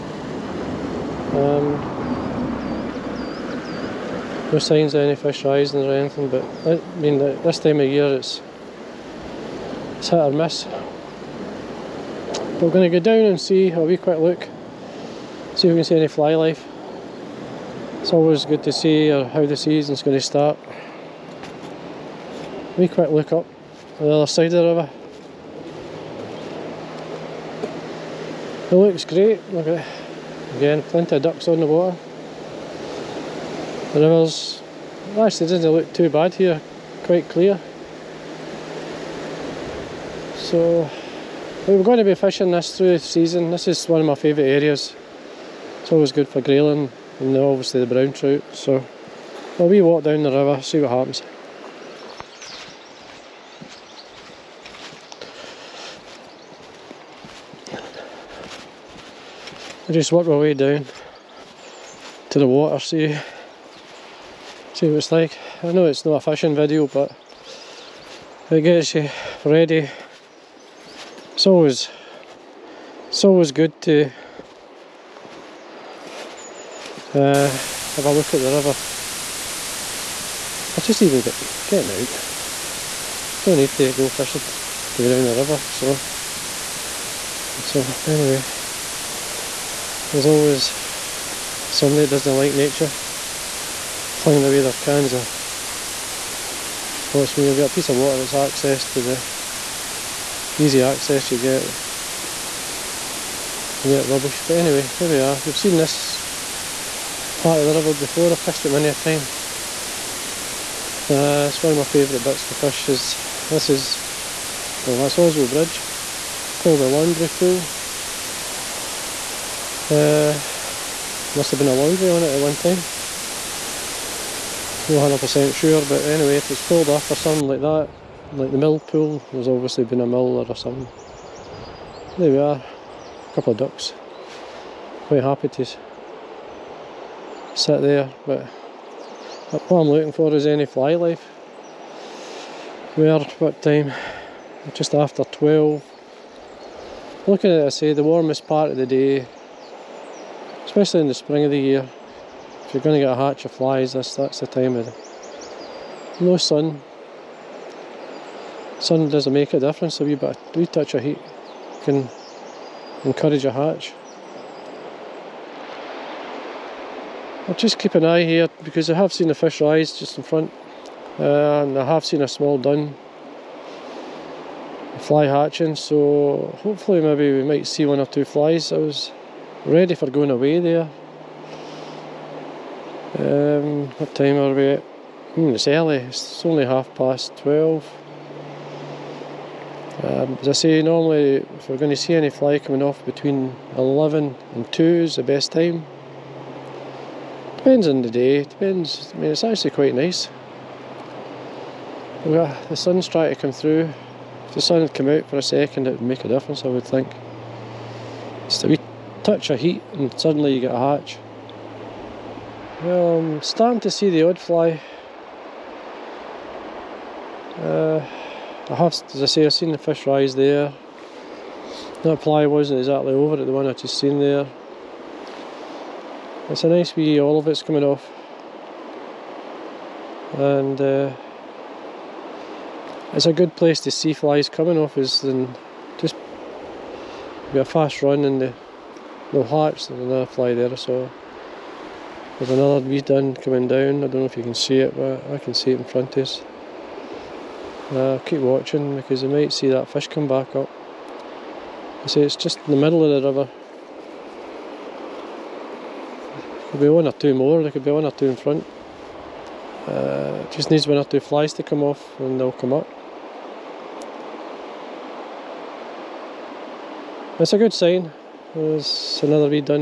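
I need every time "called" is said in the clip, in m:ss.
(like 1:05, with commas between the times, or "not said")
1:56, 2:06.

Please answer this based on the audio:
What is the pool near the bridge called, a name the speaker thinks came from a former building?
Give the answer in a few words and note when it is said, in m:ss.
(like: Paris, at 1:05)
The Laundry Pool, at 1:56.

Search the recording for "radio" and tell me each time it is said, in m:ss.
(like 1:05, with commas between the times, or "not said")
not said.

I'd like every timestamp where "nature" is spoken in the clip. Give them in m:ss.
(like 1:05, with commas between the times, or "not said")
1:32.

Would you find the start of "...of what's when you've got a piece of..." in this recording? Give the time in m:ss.
1:35.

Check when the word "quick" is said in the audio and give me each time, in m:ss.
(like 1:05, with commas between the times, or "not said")
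0:13, 0:22.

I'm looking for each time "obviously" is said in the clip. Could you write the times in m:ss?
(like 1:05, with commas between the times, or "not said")
0:47, 2:09.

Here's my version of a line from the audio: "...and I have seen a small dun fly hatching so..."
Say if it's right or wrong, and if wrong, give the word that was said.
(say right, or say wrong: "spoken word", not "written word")
right.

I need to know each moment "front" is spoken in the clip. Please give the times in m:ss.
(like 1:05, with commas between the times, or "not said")
2:50, 4:05, 4:18.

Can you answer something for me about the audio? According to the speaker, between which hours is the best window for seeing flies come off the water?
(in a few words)
11 and 2.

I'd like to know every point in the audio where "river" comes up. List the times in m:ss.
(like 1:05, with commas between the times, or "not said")
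0:24, 0:33, 0:50, 1:18, 1:25, 1:47, 4:13.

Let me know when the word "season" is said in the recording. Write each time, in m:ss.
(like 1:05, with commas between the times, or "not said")
0:19, 0:42.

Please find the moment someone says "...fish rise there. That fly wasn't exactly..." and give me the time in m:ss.
3:39.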